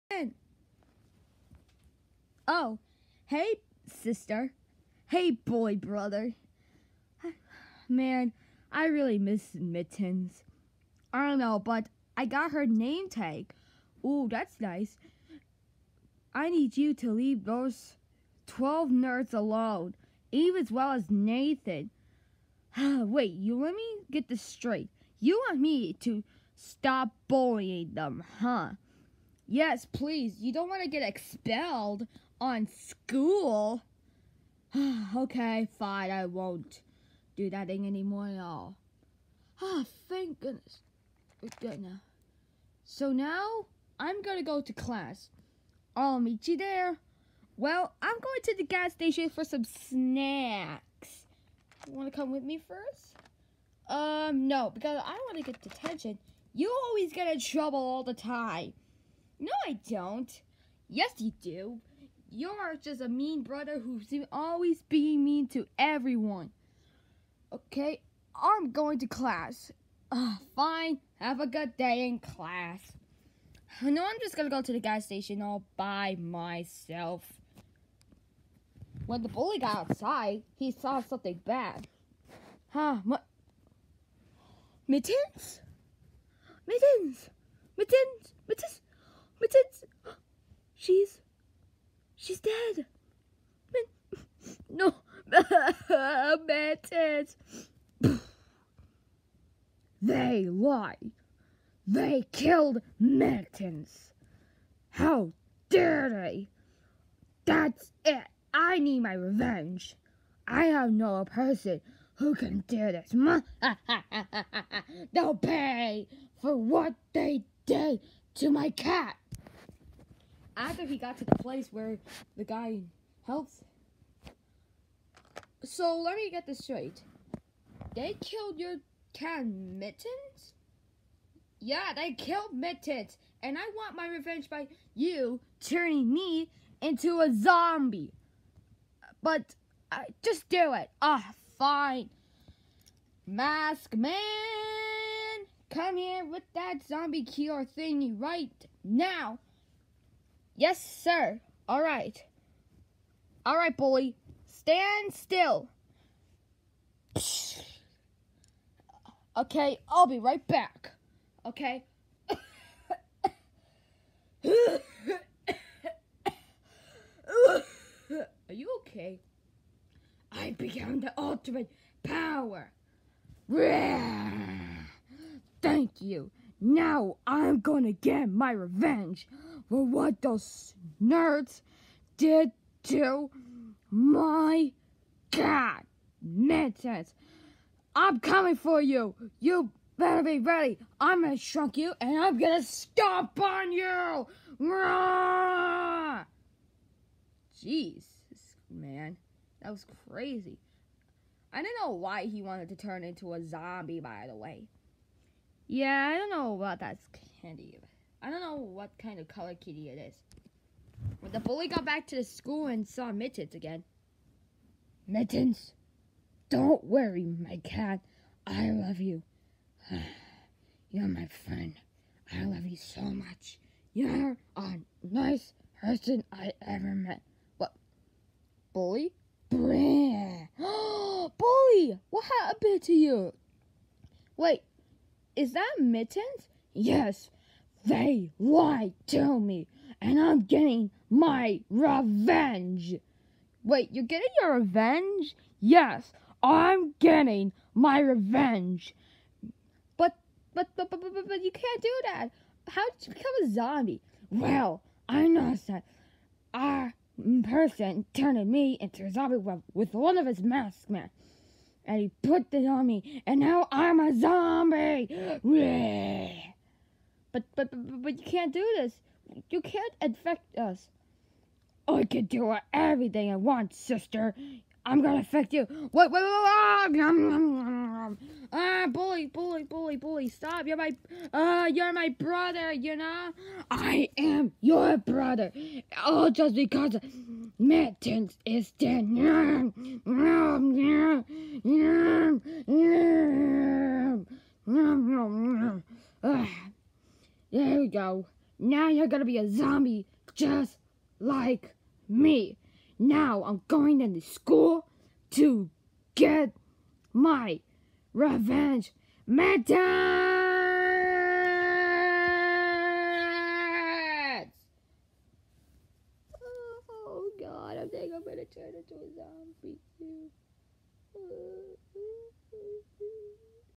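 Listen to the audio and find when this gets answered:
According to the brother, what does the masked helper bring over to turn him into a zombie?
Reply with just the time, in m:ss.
2:26.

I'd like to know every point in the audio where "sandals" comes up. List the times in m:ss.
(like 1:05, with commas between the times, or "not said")
not said.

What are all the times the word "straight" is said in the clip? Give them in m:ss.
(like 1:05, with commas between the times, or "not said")
0:24, 2:06.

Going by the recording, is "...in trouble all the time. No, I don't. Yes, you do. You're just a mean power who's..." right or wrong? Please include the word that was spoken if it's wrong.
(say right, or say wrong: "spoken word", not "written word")
wrong: "brother", not "power".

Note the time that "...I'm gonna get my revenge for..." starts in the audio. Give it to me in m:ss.
2:57.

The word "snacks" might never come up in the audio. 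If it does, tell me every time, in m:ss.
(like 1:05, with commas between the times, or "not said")
0:49.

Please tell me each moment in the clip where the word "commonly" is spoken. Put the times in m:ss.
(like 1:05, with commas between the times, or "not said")
not said.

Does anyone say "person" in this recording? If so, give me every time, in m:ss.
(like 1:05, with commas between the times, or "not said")
1:51, 3:45, 4:17.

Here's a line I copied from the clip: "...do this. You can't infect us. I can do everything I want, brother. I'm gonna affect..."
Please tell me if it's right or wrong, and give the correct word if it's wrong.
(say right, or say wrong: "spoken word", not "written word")
wrong: "sister", not "brother".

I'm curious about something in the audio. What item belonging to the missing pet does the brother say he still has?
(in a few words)
her name tag.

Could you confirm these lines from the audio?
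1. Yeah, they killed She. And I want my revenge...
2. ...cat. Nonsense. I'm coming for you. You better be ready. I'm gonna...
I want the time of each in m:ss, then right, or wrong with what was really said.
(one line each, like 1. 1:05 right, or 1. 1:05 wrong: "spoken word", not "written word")
1. 2:11 wrong: "Mittens", not "She"
2. 3:05 right.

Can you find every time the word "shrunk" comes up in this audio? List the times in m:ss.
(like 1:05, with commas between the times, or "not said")
3:11.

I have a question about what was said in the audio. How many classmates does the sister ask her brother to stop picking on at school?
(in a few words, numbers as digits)
12.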